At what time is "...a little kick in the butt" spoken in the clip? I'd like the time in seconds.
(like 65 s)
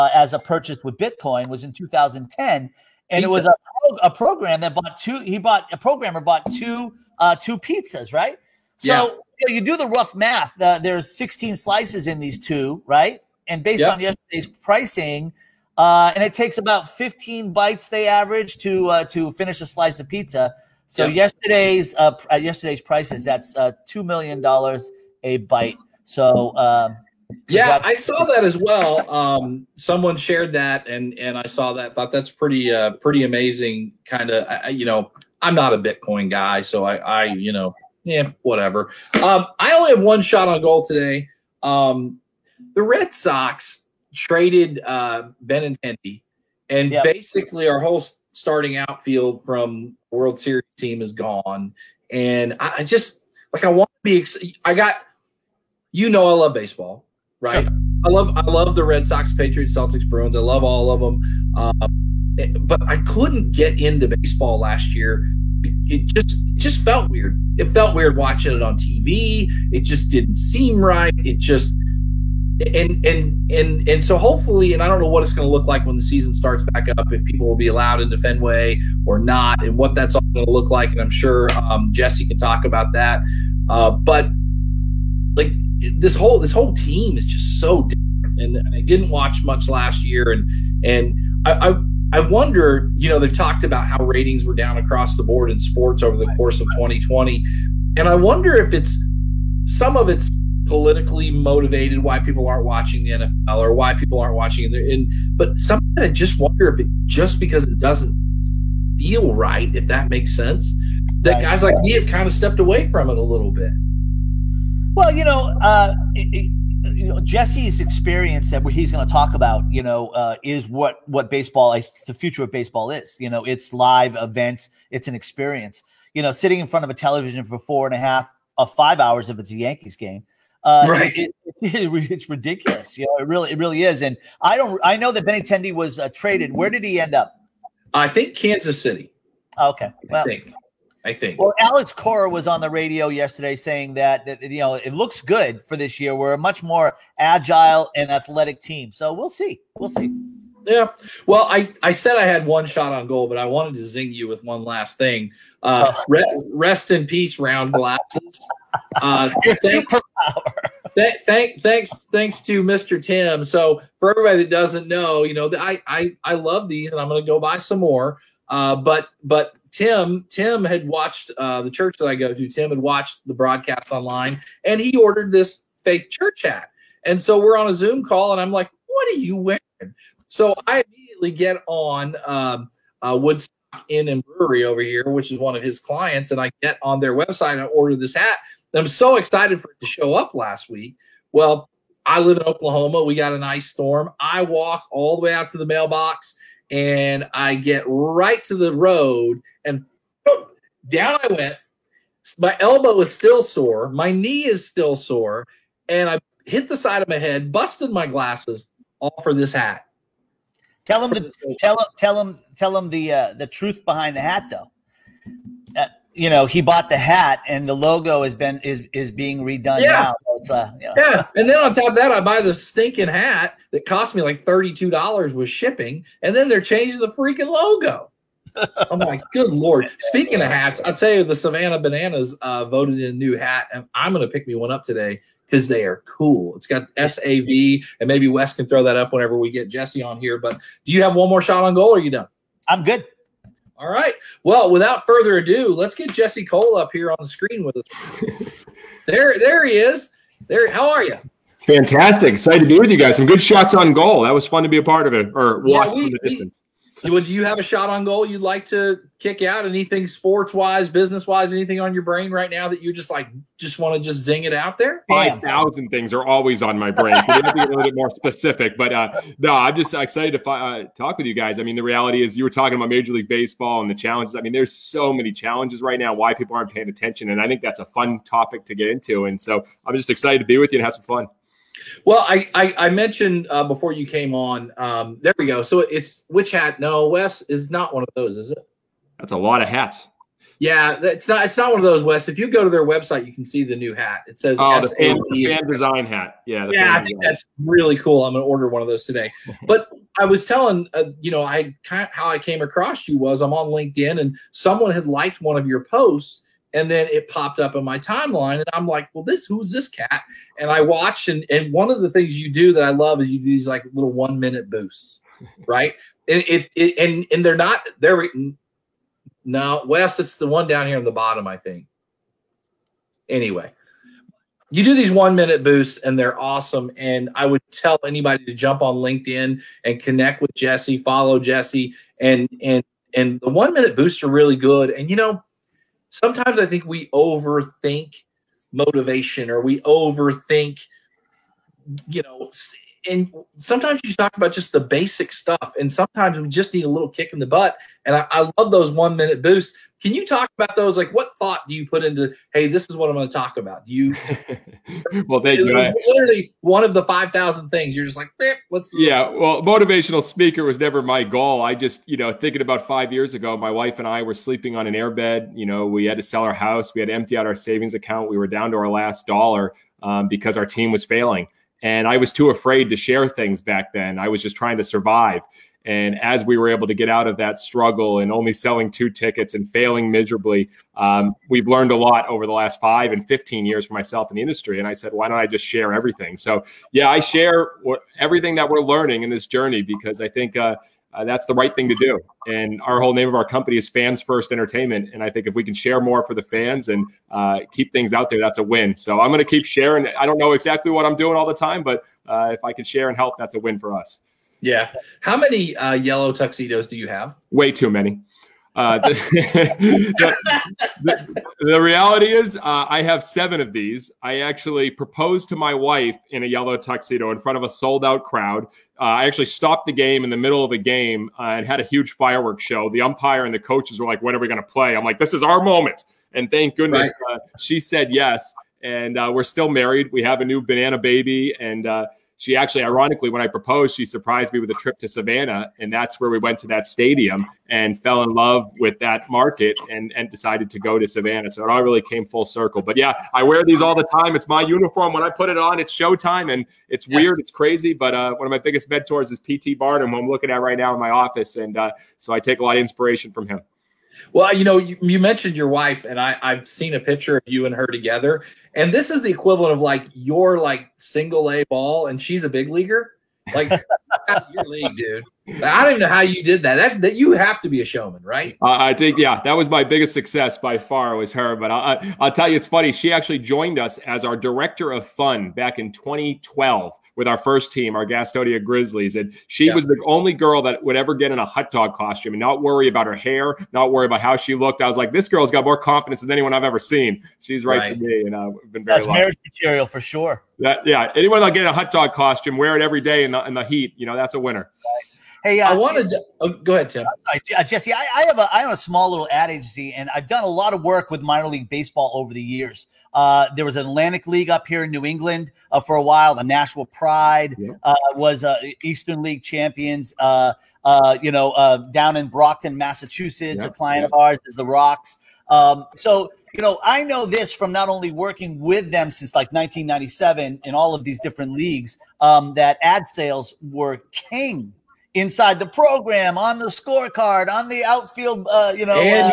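346 s.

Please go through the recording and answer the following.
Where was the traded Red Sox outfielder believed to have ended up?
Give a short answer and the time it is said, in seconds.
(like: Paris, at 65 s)
Kansas City, at 138 s.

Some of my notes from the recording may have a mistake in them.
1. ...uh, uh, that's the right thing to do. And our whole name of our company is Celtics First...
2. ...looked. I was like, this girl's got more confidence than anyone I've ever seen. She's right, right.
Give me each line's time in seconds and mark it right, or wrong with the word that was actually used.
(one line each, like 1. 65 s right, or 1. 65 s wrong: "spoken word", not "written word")
1. 390 s wrong: "Fans", not "Celtics"
2. 484 s right.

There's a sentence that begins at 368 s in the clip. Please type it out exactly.
We were down to our last dollar um, because our team was failing.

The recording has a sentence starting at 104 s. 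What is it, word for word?
And but sometimes I just wonder if it just because it doesn't feel right, if that makes sense, that right.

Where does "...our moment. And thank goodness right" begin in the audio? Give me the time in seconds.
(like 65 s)
425 s.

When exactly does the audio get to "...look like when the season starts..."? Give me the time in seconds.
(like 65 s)
75 s.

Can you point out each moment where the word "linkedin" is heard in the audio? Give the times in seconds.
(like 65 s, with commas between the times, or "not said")
303 s, 328 s.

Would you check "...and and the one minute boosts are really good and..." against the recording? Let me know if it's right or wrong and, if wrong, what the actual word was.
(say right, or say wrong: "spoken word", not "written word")
right.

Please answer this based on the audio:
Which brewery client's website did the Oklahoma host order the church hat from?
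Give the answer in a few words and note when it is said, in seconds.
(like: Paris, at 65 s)
Woodstock Inn and Brewery, at 183 s.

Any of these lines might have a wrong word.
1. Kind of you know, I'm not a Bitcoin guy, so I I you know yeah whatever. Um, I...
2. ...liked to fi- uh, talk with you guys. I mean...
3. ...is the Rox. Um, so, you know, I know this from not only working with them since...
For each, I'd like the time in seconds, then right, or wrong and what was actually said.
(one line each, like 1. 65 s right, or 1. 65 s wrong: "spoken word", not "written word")
1. 34 s right
2. 269 s wrong: "excited", not "liked"
3. 514 s right.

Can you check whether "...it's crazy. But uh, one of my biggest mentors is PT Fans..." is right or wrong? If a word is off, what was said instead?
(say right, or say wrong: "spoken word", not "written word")
wrong: "Barnum", not "Fans".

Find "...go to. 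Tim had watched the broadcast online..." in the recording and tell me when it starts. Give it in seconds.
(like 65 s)
172 s.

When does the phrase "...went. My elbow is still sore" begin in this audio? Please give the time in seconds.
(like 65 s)
201 s.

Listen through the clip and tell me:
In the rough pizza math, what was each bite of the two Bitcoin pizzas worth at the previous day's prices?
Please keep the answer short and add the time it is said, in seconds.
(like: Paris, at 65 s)
$2 million, at 23 s.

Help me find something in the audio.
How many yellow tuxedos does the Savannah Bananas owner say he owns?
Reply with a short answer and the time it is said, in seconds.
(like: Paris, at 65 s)
7, at 413 s.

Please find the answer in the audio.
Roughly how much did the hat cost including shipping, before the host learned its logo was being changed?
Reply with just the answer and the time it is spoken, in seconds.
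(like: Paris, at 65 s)
$32, at 224 s.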